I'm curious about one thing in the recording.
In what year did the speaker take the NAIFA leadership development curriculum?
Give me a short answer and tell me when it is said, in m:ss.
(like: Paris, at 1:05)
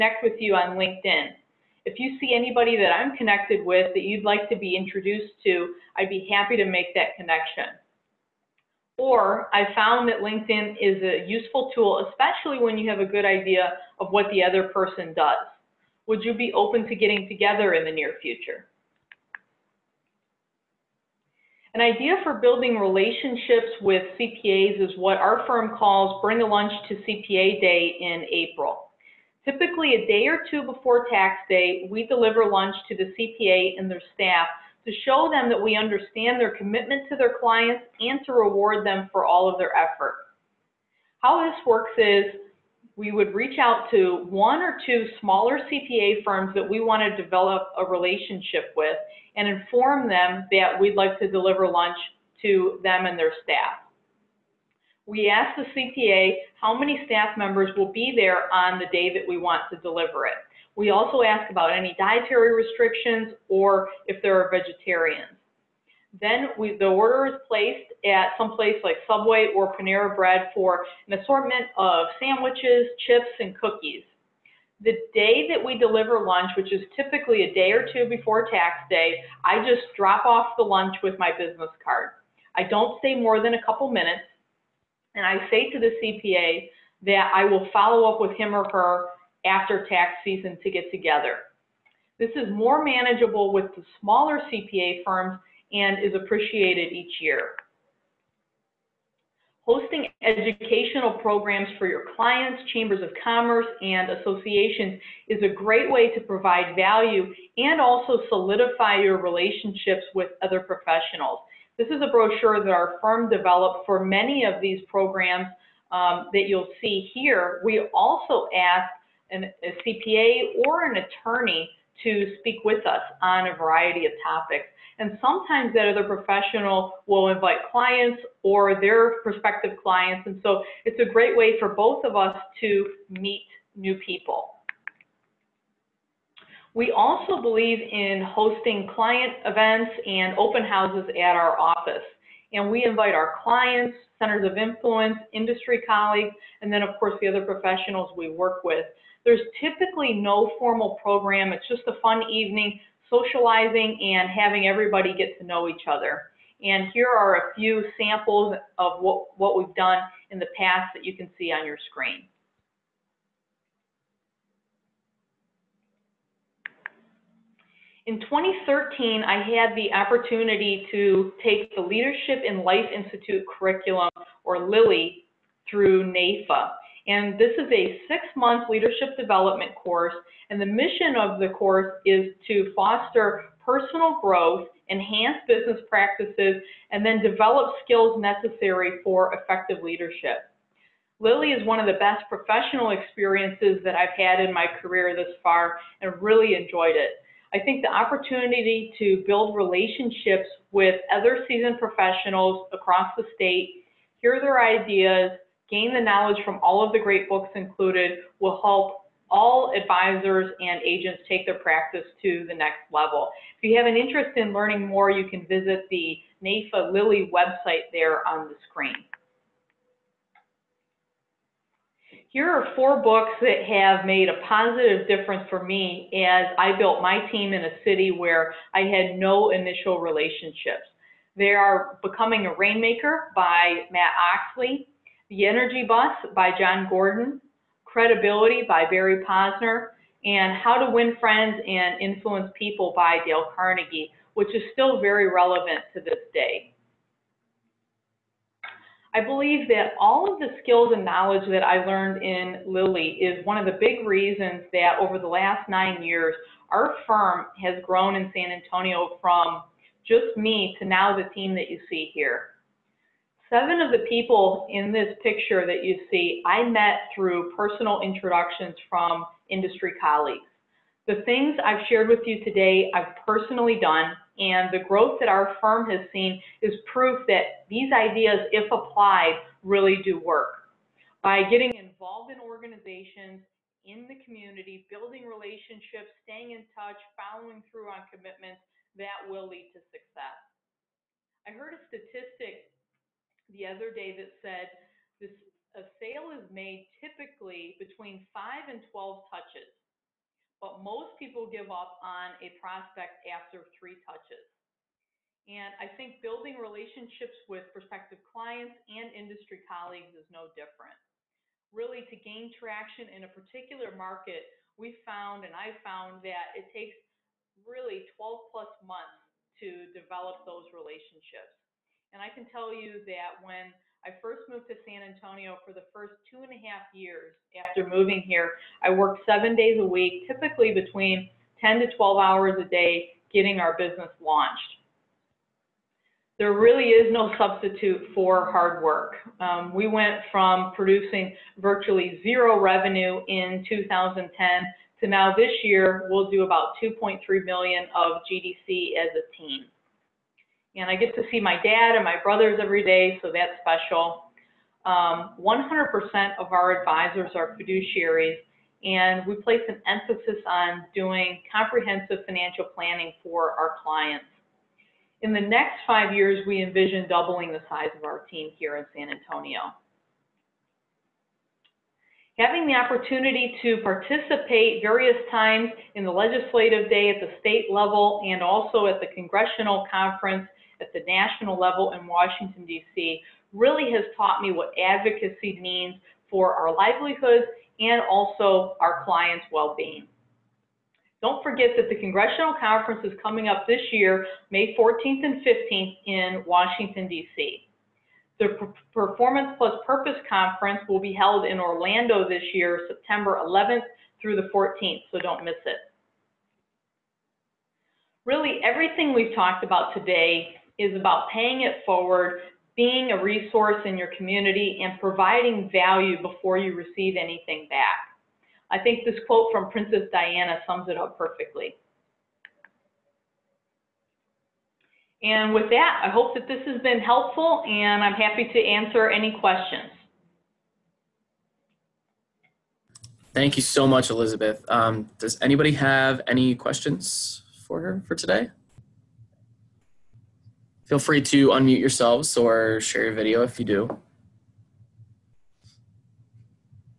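2013, at 2:48.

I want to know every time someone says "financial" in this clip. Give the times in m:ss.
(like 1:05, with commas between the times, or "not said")
6:02.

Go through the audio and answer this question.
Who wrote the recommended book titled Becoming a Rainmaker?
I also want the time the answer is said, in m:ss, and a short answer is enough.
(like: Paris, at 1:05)
Matt Oechsli, at 3:53.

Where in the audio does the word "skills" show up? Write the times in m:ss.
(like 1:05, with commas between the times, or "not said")
3:07, 4:10.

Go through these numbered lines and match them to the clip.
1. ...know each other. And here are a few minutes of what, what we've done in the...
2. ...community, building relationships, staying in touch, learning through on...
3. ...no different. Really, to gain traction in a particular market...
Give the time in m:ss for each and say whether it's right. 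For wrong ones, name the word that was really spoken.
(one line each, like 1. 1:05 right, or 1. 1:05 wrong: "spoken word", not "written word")
1. 2:35 wrong: "samples", not "minutes"
2. 4:44 wrong: "following", not "learning"
3. 5:10 right.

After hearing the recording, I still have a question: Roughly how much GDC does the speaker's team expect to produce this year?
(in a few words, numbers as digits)
2.3 million.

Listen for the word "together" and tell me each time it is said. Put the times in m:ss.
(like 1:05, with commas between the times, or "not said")
0:17, 1:30.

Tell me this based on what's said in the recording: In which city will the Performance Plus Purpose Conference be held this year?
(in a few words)
Orlando.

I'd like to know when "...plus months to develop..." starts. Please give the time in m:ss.
5:18.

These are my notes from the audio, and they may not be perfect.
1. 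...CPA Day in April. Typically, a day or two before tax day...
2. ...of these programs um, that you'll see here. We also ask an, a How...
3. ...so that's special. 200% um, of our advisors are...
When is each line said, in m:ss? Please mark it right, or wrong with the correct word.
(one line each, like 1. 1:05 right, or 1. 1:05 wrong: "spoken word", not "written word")
1. 0:26 right
2. 1:54 wrong: "CPA", not "How"
3. 5:53 wrong: "100", not "200".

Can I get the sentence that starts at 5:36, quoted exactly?
There really is no substitute for hard work.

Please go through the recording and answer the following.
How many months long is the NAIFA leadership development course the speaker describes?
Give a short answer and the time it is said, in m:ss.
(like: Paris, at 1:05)
six, at 2:58.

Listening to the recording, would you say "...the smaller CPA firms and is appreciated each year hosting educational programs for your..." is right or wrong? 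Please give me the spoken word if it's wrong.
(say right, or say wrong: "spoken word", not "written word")
right.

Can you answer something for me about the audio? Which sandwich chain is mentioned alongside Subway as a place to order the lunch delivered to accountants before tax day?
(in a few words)
Panera Bread.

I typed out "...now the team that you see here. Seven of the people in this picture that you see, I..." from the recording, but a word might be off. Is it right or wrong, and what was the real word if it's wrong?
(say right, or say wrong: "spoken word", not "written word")
right.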